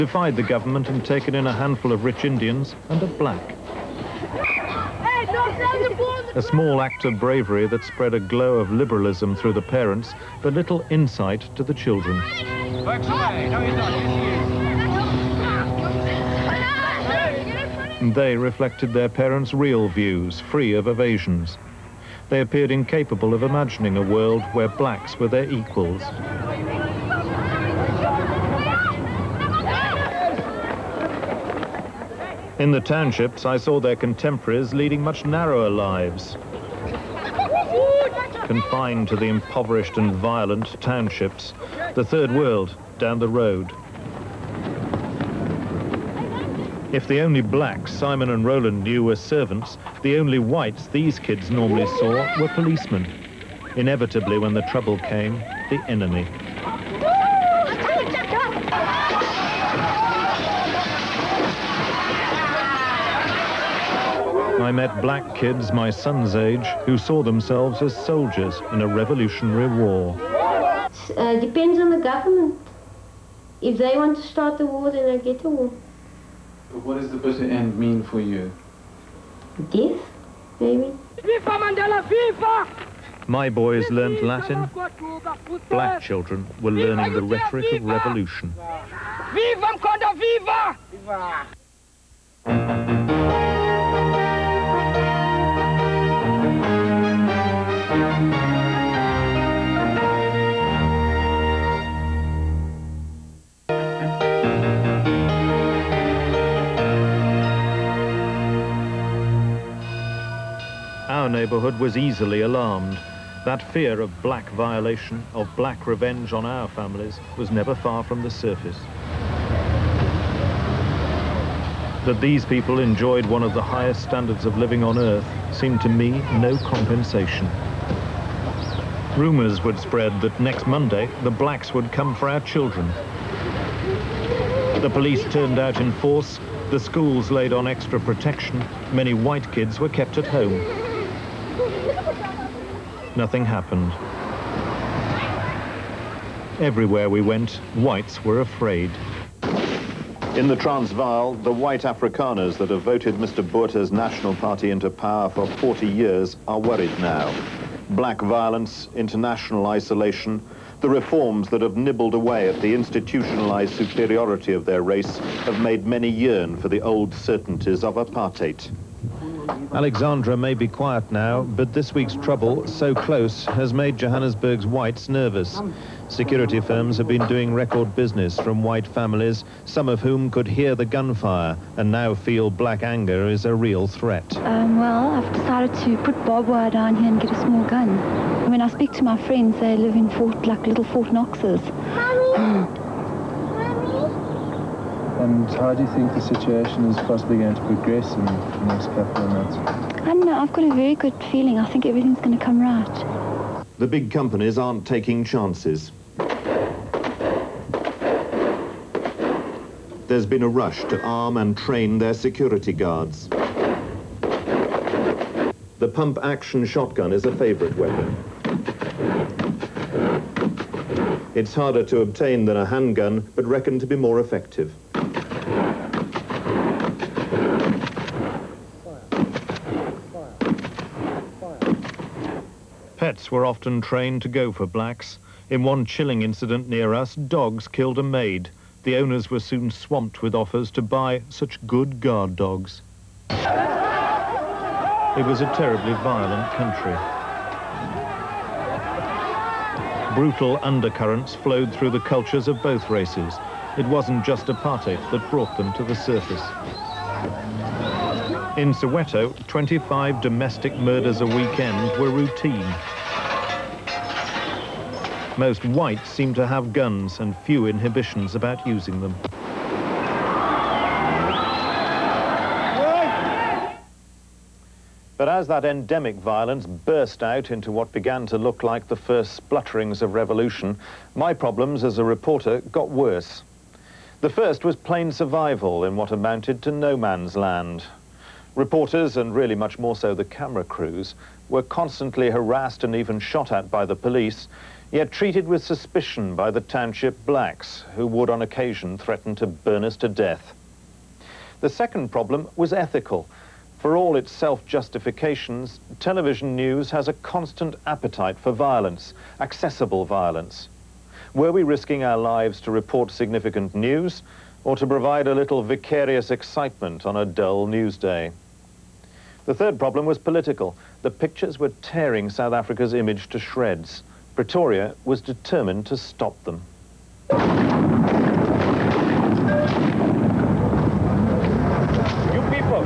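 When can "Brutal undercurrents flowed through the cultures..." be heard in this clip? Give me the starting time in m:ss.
4:10.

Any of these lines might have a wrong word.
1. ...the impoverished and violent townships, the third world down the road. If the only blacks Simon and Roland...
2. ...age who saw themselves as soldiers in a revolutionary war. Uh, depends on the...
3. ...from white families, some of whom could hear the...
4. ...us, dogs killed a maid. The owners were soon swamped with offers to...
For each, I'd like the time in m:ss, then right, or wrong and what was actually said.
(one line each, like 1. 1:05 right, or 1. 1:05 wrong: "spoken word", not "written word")
1. 0:39 right
2. 1:06 right
3. 2:58 right
4. 3:56 right.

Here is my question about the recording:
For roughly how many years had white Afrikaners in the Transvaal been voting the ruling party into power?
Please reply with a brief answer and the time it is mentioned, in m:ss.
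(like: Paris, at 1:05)
40 years, at 2:35.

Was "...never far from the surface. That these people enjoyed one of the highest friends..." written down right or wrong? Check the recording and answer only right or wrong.
wrong.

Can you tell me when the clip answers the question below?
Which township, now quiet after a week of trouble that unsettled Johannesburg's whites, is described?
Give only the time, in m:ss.
2:49.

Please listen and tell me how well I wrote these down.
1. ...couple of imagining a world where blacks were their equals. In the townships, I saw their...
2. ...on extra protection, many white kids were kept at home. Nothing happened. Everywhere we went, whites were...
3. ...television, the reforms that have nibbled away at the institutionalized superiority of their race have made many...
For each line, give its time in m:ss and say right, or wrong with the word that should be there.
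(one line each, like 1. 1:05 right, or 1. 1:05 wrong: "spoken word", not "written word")
1. 0:22 wrong: "incapable", not "couple"
2. 2:17 right
3. 2:39 wrong: "isolation", not "television".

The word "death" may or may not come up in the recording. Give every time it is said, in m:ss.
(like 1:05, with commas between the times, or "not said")
1:19, 5:00.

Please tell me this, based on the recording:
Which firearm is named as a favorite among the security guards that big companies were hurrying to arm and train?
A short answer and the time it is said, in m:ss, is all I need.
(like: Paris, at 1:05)
pump action shotgun, at 3:35.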